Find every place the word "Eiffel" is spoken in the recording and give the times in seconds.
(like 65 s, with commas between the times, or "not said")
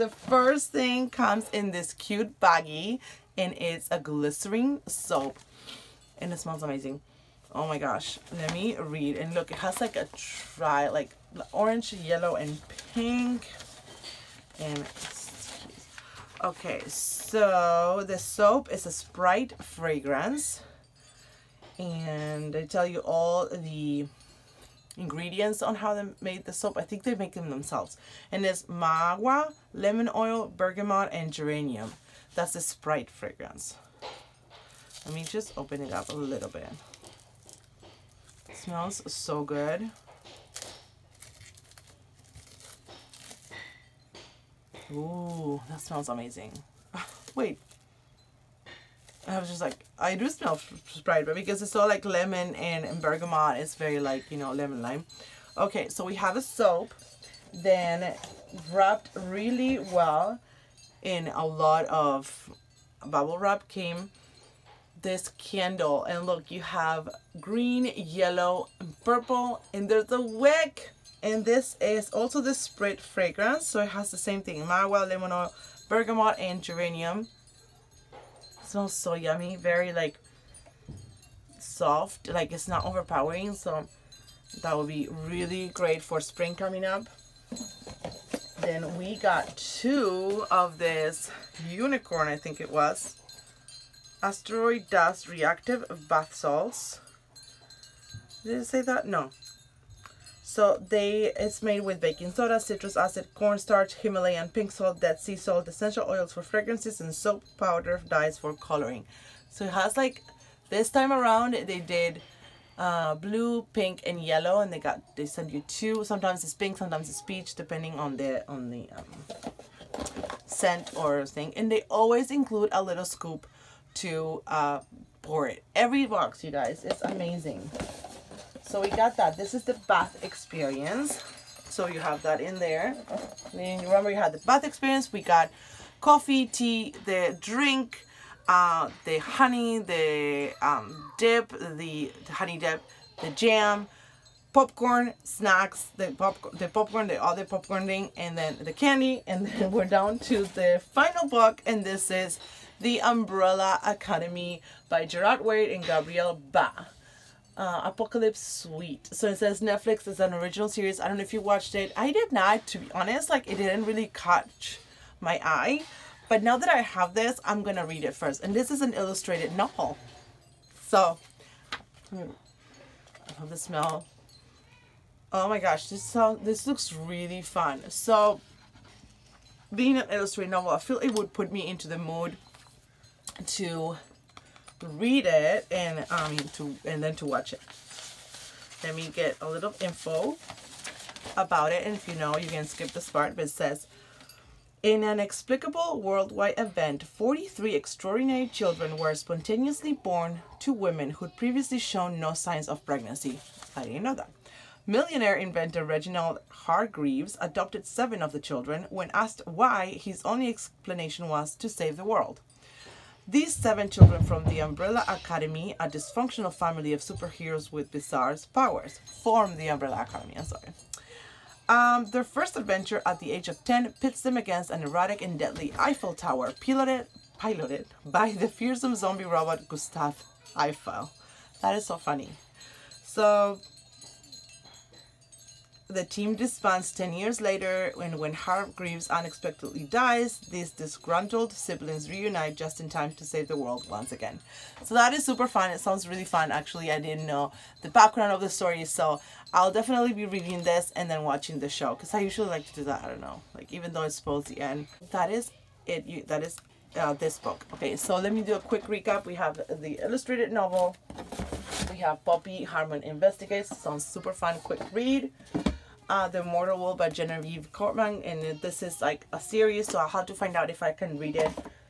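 225 s, 230 s.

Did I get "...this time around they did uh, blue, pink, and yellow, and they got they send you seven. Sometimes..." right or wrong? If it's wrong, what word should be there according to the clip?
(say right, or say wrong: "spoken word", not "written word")
wrong: "two", not "seven".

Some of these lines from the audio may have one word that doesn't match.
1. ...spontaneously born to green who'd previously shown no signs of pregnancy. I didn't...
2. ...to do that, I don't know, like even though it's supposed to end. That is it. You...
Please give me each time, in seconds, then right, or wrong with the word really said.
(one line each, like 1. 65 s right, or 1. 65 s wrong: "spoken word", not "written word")
1. 199 s wrong: "women", not "green"
2. 252 s right.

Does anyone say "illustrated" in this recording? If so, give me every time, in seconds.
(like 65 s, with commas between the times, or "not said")
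168 s, 180 s, 260 s.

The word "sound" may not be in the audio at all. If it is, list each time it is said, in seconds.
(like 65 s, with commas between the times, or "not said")
176 s, 245 s, 263 s.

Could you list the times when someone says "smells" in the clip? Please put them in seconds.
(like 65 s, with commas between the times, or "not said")
6 s, 38 s, 45 s, 50 s, 78 s, 173 s.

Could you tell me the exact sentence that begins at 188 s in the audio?
Let me get a little info about it.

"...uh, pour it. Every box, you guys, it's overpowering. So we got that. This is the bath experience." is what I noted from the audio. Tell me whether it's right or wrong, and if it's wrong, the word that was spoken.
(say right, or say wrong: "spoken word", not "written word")
wrong: "amazing", not "overpowering".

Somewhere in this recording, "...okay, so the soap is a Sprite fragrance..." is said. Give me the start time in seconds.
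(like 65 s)
16 s.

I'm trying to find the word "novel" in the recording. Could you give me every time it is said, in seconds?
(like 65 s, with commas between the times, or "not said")
169 s, 180 s, 260 s.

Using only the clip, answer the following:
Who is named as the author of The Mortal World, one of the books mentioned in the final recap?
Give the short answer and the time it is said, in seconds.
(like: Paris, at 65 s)
Genevieve Cogman, at 267 s.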